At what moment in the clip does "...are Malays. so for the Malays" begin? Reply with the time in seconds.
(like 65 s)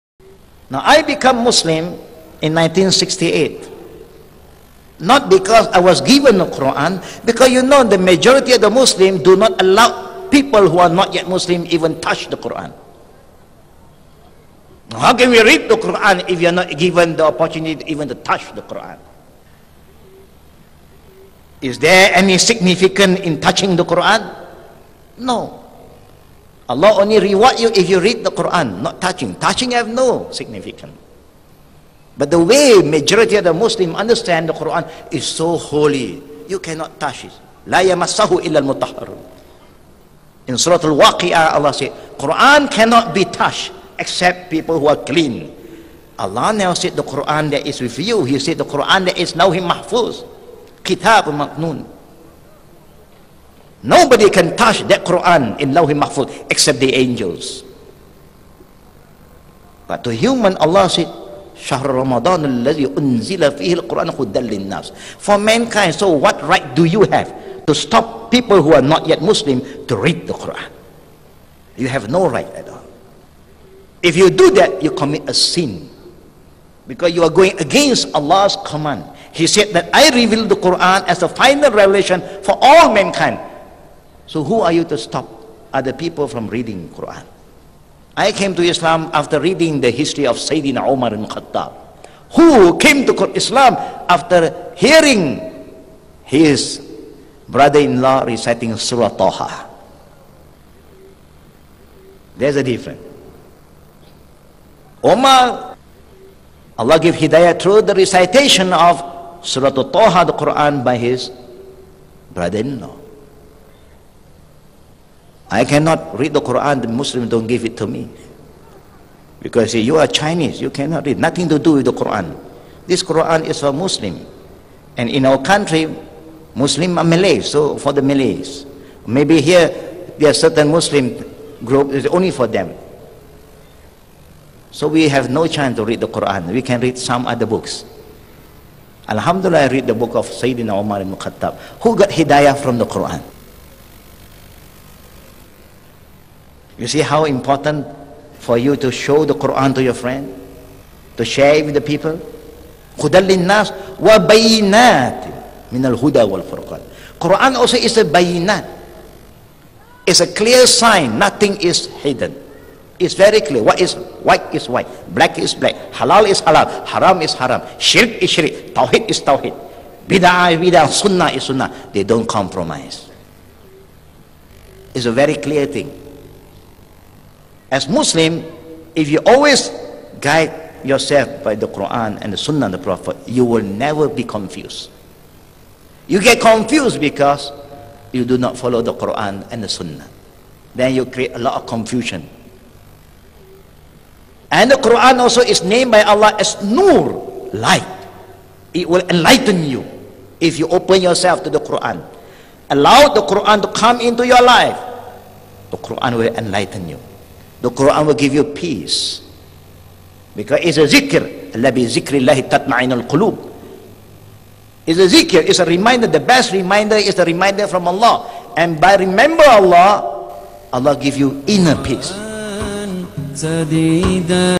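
126 s.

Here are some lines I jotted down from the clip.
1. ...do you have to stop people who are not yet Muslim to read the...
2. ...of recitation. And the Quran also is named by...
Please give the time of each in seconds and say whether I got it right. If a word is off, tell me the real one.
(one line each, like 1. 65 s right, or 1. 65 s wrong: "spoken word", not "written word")
1. 66 s right
2. 191 s wrong: "confusion", not "recitation".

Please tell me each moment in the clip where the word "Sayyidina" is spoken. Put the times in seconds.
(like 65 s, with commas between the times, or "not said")
90 s, 140 s.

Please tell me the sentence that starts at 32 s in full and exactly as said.
But the way majority of the Muslim understand the Quran is so holy, you cannot touch it.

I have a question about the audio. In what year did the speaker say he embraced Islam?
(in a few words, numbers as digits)
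1968.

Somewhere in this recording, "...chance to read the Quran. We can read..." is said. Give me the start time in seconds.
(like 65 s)
135 s.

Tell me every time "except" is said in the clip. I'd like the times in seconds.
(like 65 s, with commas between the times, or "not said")
43 s, 56 s.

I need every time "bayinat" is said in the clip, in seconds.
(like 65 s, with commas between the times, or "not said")
152 s, 158 s.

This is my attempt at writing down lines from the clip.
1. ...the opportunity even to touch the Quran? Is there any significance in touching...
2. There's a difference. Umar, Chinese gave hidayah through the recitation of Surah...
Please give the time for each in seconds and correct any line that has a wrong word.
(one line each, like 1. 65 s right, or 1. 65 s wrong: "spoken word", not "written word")
1. 17 s right
2. 102 s wrong: "Allah", not "Chinese".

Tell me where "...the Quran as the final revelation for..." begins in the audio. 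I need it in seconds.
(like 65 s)
80 s.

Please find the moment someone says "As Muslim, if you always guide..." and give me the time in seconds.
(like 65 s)
177 s.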